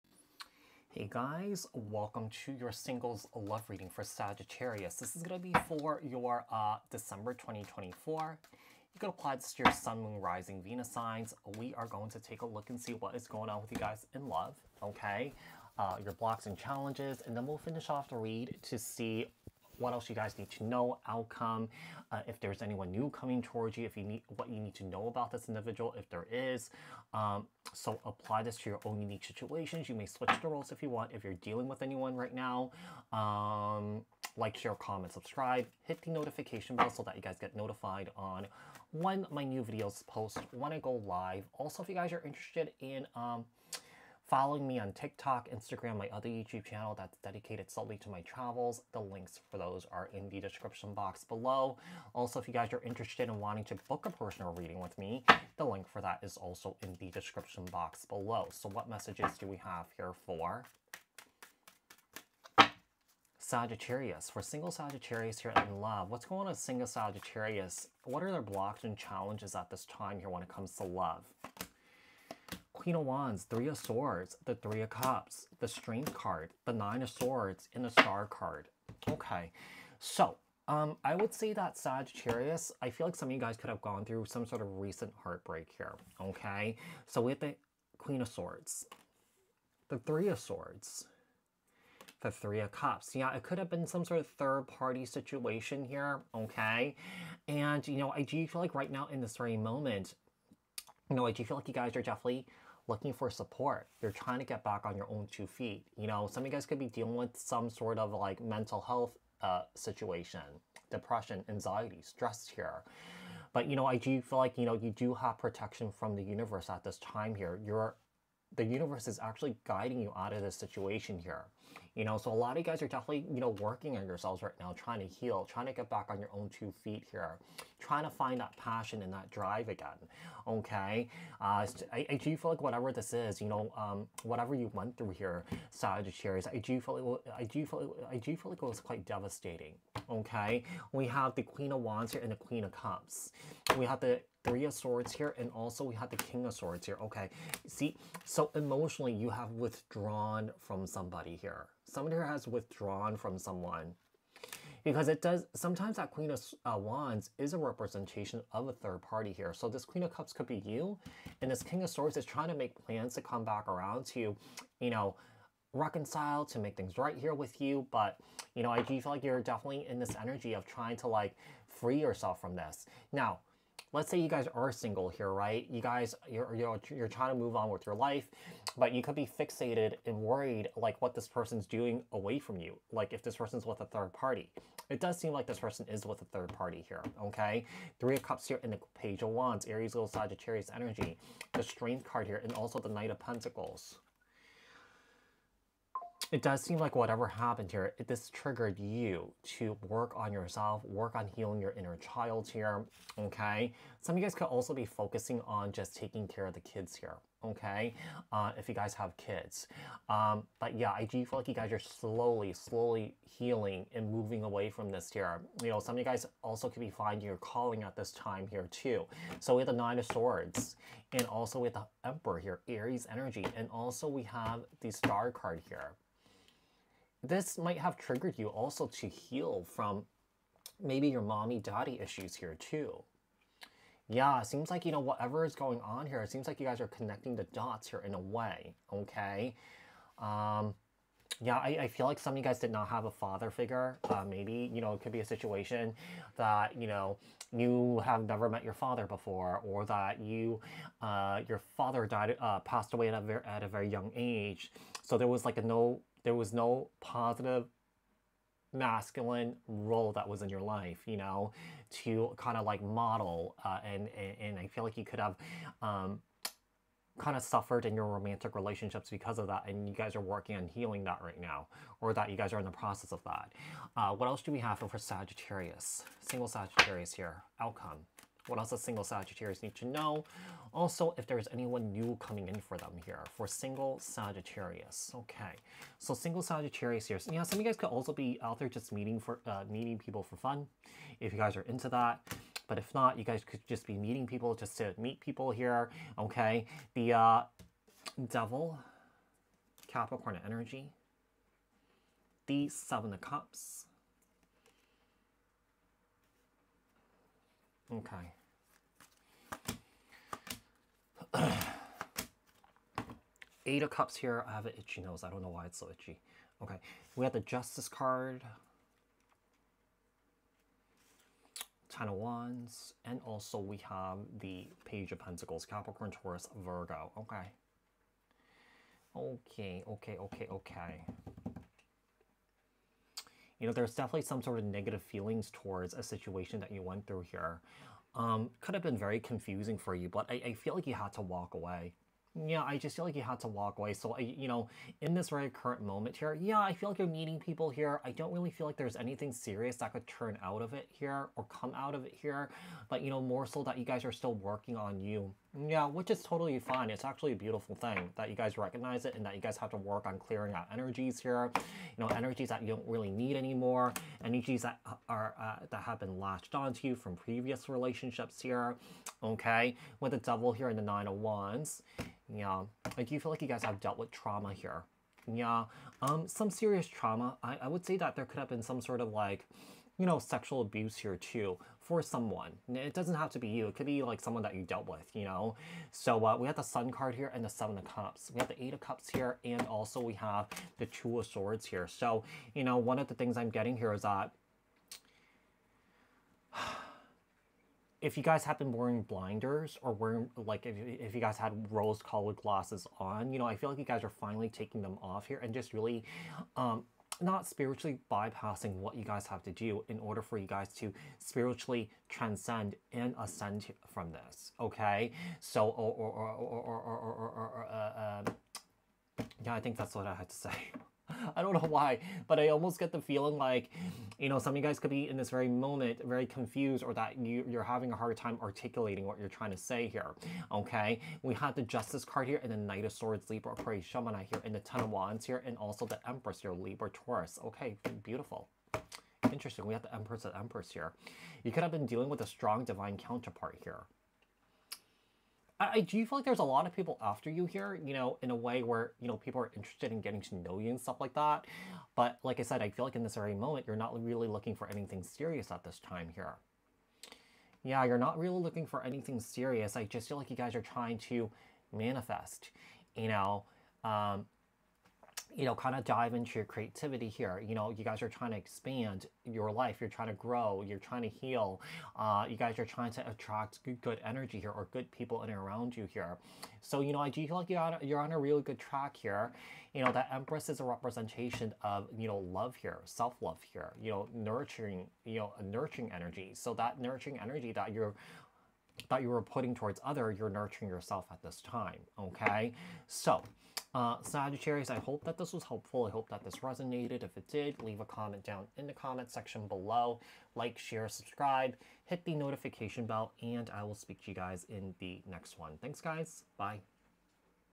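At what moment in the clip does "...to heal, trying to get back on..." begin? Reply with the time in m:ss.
2:05.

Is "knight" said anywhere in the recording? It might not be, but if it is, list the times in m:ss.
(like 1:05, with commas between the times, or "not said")
3:12, 7:12.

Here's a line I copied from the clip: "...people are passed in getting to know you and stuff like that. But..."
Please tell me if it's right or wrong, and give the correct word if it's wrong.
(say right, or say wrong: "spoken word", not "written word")
wrong: "interested", not "passed".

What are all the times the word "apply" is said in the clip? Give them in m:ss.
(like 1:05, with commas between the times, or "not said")
0:09, 0:28.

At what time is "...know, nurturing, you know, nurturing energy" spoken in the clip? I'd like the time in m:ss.
8:03.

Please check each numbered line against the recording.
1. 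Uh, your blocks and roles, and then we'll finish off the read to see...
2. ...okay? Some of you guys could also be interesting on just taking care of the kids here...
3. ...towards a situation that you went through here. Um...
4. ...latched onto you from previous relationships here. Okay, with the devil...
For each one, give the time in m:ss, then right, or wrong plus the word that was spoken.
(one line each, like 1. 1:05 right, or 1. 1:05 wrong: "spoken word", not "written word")
1. 0:15 wrong: "challenges", not "roles"
2. 3:23 wrong: "focusing", not "interesting"
3. 5:35 right
4. 6:06 right.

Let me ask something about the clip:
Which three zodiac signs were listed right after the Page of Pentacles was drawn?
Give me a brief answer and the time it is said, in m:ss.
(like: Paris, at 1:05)
Capricorn, Taurus, Virgo, at 5:25.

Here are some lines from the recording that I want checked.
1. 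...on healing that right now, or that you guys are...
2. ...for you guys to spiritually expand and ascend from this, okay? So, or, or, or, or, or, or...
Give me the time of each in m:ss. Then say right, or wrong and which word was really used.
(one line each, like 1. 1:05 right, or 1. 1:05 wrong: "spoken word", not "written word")
1. 4:30 right
2. 6:50 wrong: "transcend", not "expand".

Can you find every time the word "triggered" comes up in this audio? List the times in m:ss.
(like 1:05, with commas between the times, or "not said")
3:18, 3:47.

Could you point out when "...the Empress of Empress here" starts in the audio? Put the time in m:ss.
7:19.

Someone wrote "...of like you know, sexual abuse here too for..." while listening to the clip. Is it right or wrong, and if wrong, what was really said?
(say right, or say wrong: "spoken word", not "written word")
right.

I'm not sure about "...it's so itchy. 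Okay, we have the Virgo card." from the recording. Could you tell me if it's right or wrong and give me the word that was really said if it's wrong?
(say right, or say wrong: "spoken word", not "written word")
wrong: "Justice", not "Virgo".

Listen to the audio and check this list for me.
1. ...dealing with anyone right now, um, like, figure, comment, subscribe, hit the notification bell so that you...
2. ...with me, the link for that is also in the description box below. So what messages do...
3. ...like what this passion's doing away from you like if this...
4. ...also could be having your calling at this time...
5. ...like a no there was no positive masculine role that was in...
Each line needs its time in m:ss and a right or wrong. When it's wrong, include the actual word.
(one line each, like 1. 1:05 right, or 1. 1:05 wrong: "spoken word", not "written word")
1. 0:31 wrong: "share", not "figure"
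2. 0:54 right
3. 3:00 wrong: "person", not "passion"
4. 3:36 wrong: "finding", not "having"
5. 4:15 right.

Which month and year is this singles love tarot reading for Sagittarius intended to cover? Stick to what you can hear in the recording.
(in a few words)
December 2024.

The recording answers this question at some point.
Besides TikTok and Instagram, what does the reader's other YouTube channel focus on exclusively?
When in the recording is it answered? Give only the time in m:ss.
0:48.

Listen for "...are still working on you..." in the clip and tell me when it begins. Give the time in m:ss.
5:54.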